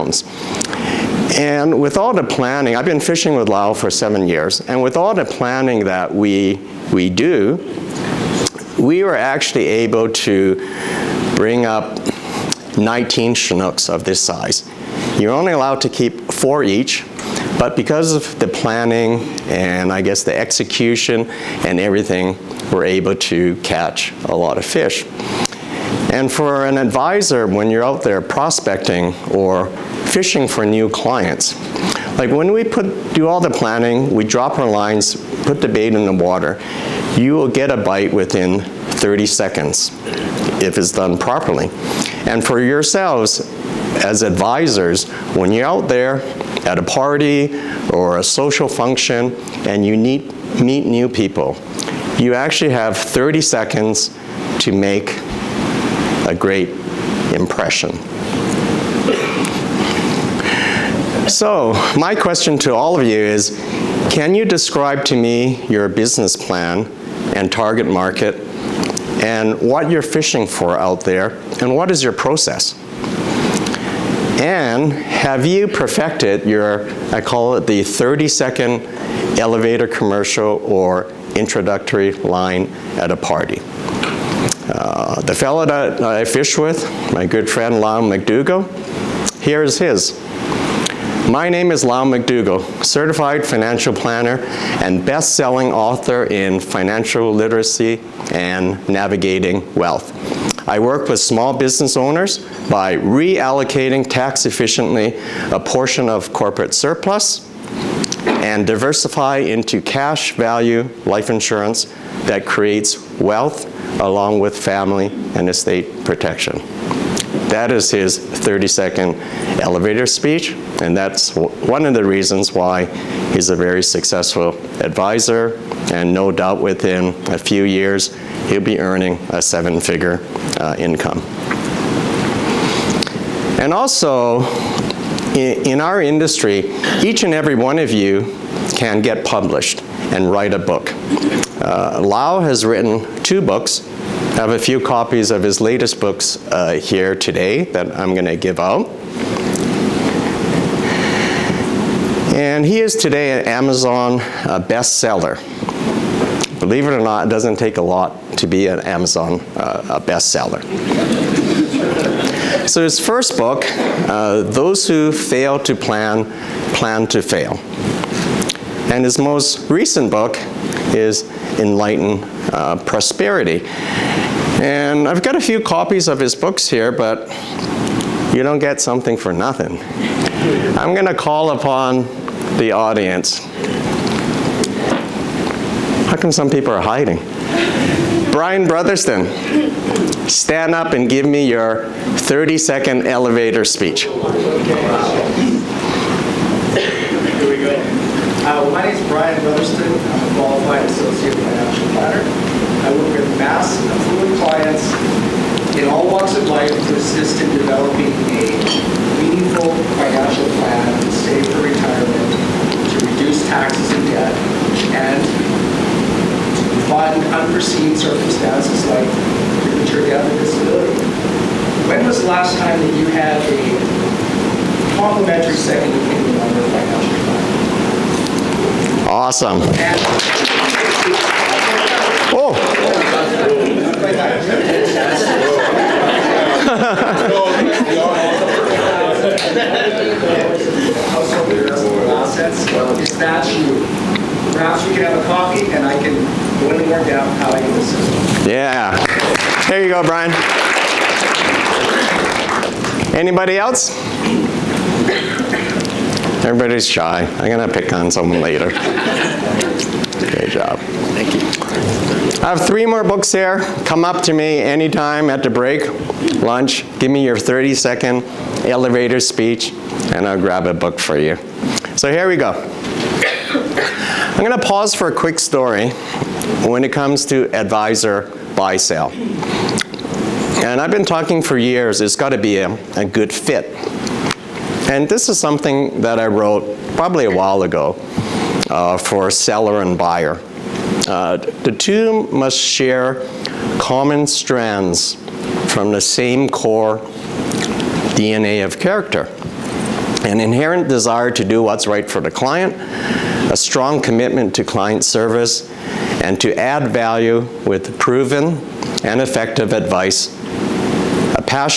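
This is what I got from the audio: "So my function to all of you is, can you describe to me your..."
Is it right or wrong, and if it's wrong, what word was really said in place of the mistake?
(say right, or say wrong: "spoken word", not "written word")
wrong: "question", not "function".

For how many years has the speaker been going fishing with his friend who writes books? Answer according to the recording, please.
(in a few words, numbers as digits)
7.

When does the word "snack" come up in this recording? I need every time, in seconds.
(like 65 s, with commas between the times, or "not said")
not said.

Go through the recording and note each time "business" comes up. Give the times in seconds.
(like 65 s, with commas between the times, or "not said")
65 s, 101 s.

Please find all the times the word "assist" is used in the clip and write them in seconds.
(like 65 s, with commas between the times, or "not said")
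206 s, 247 s.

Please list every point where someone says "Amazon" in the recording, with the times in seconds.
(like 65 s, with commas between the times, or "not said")
153 s, 158 s.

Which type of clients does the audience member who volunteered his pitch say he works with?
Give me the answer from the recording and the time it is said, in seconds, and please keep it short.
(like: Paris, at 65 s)
mass affluent clients, at 203 s.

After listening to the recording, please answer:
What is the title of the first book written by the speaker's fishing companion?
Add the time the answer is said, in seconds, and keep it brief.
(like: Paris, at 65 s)
Those Who Fail to Plan, Plan to Fail, at 164 s.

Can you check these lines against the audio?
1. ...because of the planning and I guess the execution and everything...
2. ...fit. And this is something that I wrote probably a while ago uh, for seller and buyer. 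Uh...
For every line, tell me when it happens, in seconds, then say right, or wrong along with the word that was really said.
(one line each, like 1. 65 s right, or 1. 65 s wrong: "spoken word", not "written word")
1. 17 s right
2. 283 s right.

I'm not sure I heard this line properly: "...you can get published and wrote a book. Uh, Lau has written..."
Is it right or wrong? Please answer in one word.
wrong.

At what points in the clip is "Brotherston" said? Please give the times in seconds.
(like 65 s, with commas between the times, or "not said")
188 s, 199 s.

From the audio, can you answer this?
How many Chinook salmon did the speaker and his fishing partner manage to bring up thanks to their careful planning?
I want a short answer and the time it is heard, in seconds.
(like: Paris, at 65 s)
19, at 12 s.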